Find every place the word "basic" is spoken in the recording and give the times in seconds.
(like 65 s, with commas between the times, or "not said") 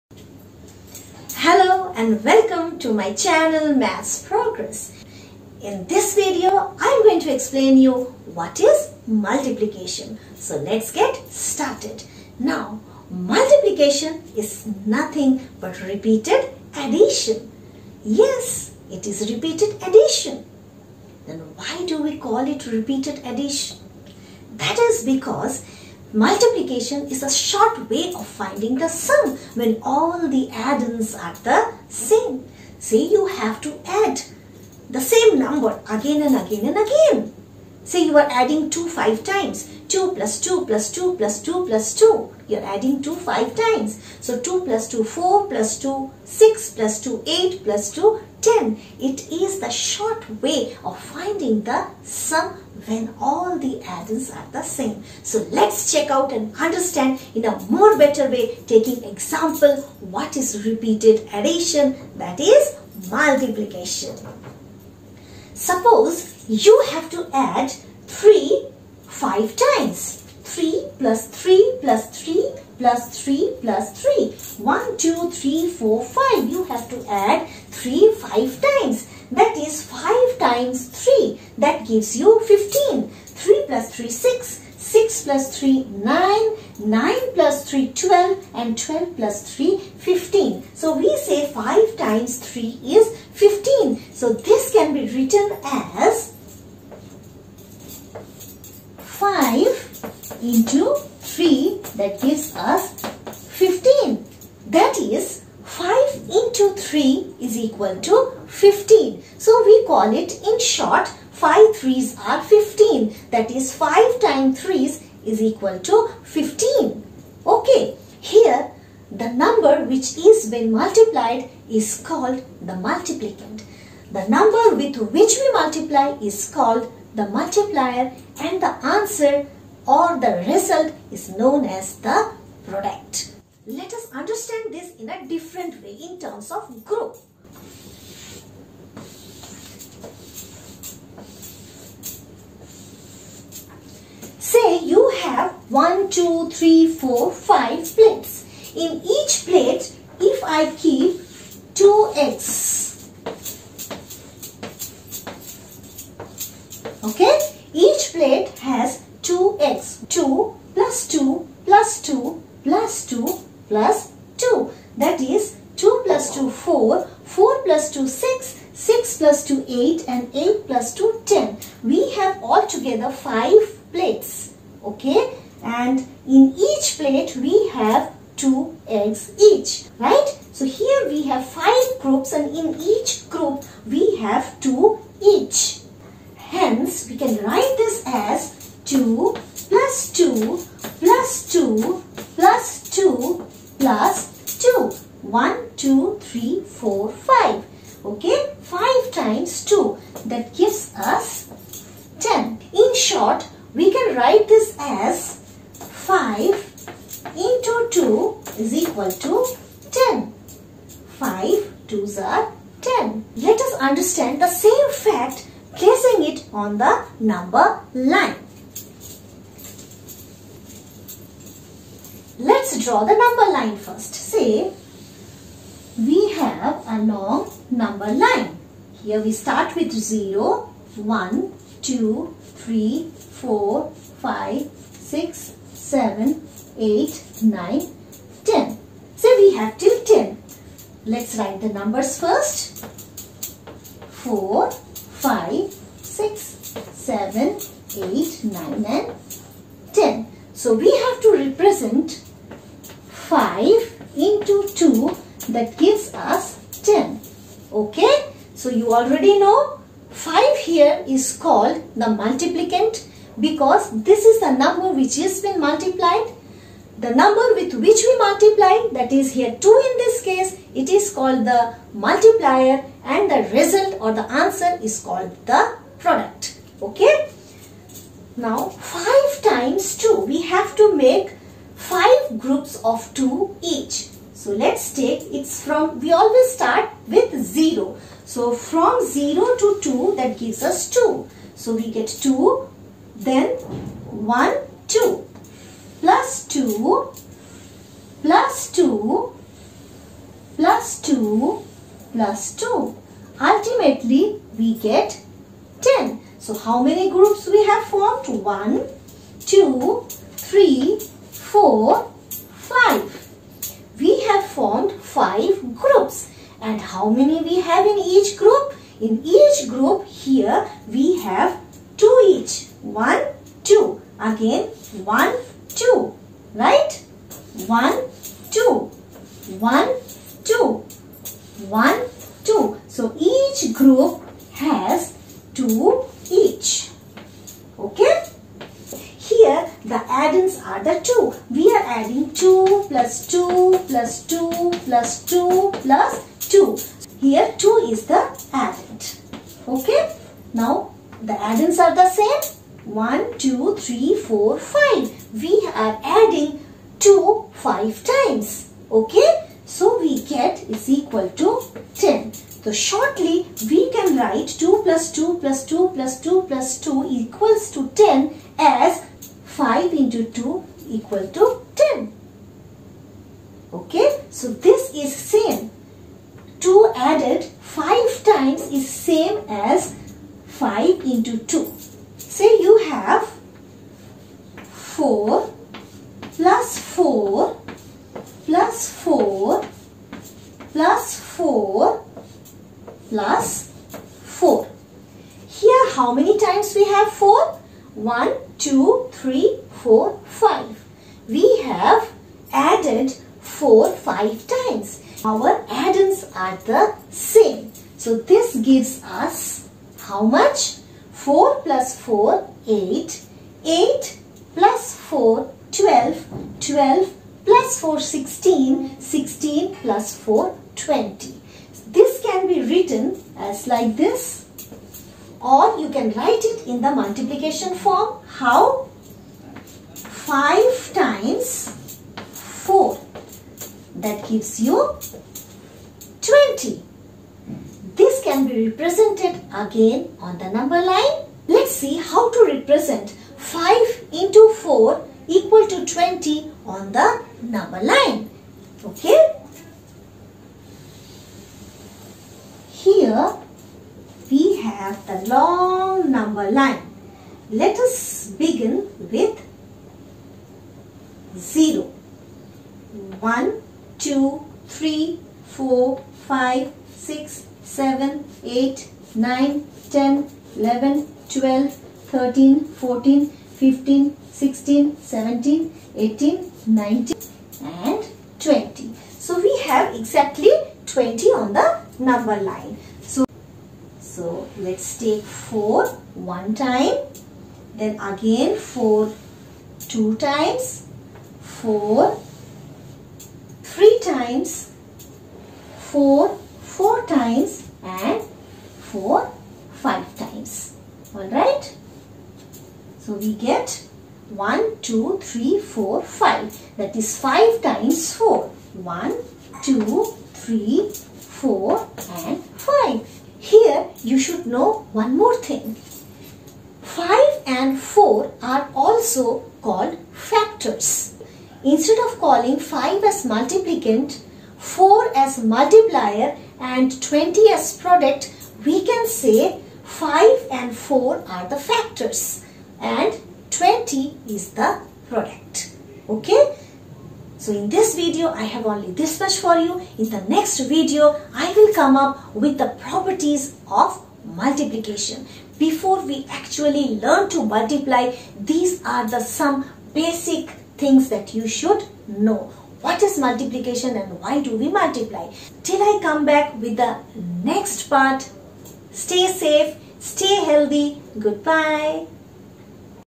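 549 s.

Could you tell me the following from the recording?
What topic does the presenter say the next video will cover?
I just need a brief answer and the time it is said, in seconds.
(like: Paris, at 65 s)
properties of multiplication, at 542 s.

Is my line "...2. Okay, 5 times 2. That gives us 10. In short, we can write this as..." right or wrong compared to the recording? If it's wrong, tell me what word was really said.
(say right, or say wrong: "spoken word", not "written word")
right.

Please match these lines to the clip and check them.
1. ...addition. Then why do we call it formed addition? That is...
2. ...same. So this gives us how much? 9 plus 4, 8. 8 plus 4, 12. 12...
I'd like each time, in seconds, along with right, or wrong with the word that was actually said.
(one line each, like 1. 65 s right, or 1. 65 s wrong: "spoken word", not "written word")
1. 19 s wrong: "repeated", not "formed"
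2. 407 s wrong: "4", not "9".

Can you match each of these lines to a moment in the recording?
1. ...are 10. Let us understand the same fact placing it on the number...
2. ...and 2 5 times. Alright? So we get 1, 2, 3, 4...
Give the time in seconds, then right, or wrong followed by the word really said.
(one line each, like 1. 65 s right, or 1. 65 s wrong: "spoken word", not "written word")
1. 212 s right
2. 497 s wrong: "4", not "2".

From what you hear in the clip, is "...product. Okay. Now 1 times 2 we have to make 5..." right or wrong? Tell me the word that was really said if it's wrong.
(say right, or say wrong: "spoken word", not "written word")
wrong: "5", not "1".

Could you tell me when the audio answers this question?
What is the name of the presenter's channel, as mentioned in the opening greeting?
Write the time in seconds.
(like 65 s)
3 s.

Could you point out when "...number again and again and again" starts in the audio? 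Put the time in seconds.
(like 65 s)
35 s.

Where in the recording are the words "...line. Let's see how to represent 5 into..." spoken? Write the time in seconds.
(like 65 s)
440 s.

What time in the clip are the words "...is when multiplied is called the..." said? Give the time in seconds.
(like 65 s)
120 s.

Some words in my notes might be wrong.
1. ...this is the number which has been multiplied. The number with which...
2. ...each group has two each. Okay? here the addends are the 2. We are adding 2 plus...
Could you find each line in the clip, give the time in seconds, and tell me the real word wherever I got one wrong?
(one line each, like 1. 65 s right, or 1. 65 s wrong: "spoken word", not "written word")
1. 264 s right
2. 333 s right.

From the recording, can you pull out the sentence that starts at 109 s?
So we call it in short 5 threes are 15.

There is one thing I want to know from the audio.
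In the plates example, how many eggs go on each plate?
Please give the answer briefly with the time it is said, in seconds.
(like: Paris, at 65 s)
2, at 151 s.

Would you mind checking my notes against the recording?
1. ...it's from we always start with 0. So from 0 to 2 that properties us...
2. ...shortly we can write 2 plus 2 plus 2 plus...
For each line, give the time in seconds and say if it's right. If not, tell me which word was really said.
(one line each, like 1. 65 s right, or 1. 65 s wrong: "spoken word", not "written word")
1. 285 s wrong: "gives", not "properties"
2. 362 s right.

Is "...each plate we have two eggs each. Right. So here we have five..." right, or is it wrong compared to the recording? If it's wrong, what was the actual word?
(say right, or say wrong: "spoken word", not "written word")
right.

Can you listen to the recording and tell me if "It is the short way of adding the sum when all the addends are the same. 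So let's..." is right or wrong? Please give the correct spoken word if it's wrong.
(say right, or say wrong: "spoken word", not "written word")
wrong: "finding", not "adding".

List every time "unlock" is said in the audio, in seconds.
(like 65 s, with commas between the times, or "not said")
not said.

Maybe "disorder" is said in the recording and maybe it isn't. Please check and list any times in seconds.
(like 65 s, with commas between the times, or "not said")
not said.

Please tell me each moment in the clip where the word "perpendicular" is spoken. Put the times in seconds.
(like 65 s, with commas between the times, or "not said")
not said.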